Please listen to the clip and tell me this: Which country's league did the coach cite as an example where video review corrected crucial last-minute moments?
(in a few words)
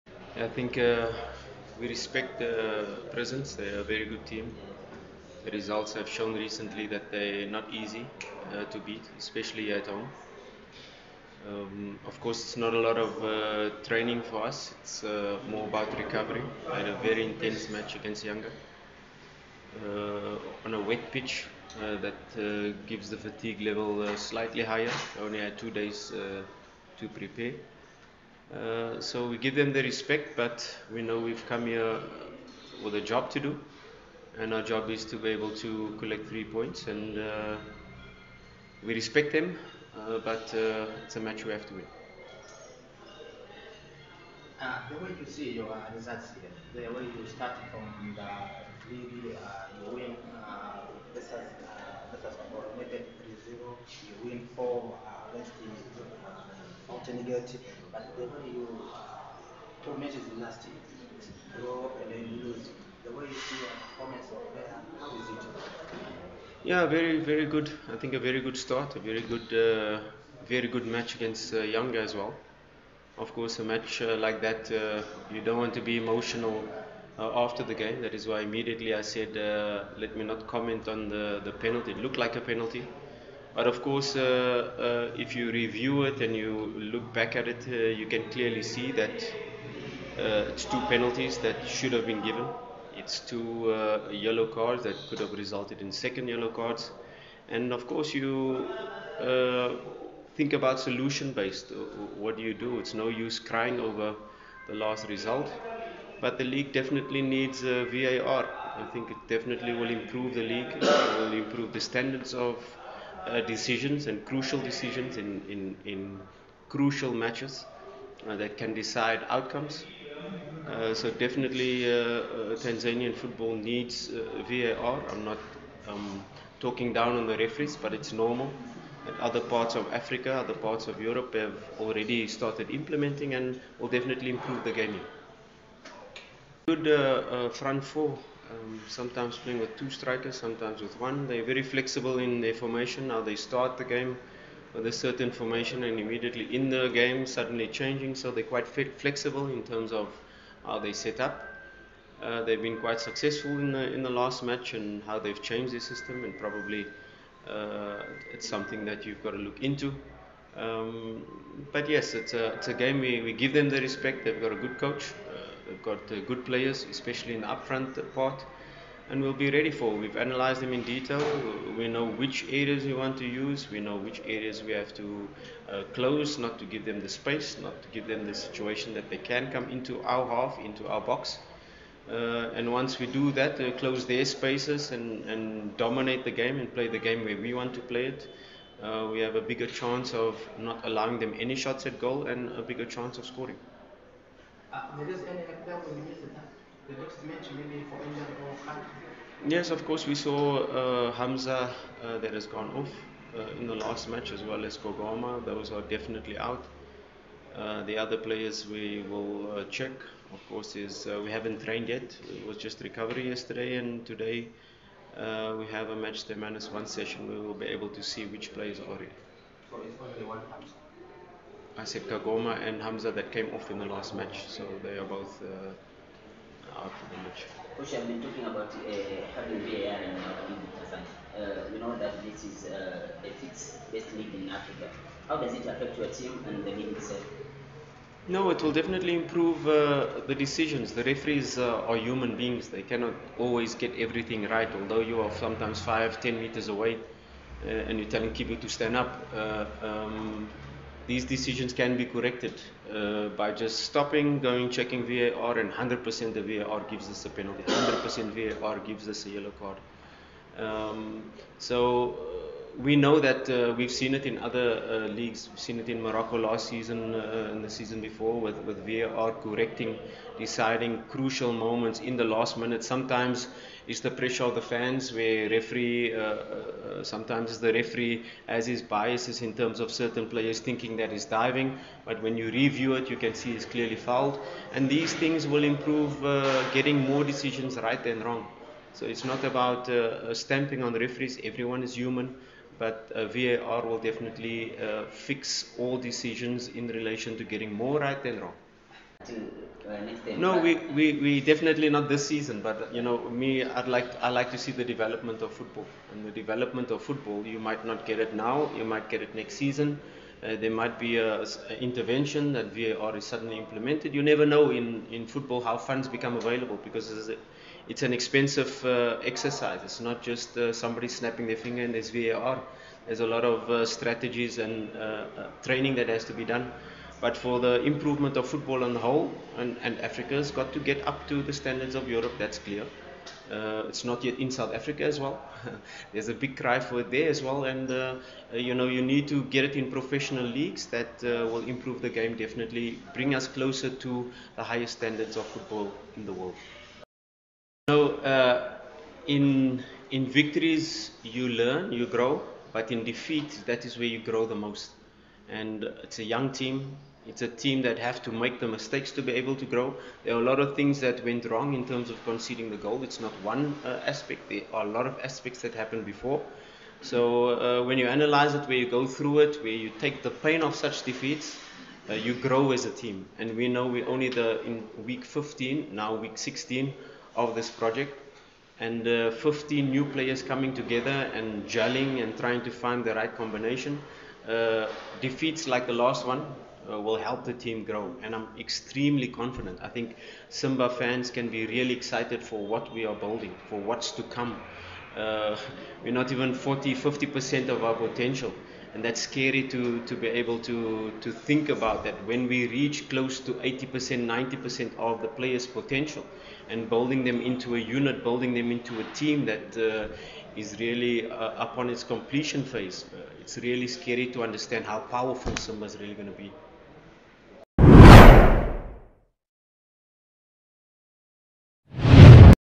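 Morocco.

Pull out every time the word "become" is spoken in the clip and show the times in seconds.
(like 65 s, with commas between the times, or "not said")
316 s.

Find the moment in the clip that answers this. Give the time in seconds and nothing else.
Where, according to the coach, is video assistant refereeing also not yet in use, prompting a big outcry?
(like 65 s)
334 s.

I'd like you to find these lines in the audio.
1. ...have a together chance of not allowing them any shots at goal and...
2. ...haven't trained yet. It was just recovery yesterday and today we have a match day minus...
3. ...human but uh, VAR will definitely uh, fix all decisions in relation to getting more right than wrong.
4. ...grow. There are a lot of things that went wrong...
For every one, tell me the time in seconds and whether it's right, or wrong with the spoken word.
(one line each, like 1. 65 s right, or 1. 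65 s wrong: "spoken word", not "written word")
1. 189 s wrong: "bigger", not "together"
2. 211 s right
3. 291 s right
4. 359 s right.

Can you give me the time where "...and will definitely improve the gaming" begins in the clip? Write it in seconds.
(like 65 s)
133 s.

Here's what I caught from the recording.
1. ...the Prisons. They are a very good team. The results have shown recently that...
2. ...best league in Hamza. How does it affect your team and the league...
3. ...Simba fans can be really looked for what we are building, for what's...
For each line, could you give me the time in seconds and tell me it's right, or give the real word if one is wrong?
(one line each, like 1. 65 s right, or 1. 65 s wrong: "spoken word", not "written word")
1. 2 s right
2. 233 s wrong: "Africa", not "Hamza"
3. 390 s wrong: "excited", not "looked".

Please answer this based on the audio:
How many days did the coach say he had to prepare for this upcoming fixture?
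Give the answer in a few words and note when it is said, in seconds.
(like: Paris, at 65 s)
2, at 25 s.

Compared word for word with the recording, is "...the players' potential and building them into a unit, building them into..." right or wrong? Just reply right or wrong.
right.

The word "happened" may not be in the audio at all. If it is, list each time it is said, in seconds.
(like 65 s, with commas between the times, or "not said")
365 s.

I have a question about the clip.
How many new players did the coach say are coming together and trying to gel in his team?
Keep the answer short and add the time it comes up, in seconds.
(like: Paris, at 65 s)
15, at 379 s.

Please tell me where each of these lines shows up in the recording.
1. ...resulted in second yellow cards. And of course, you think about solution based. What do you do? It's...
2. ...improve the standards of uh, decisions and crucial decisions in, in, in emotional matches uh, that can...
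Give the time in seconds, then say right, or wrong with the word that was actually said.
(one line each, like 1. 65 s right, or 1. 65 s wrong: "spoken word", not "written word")
1. 95 s right
2. 111 s wrong: "crucial", not "emotional".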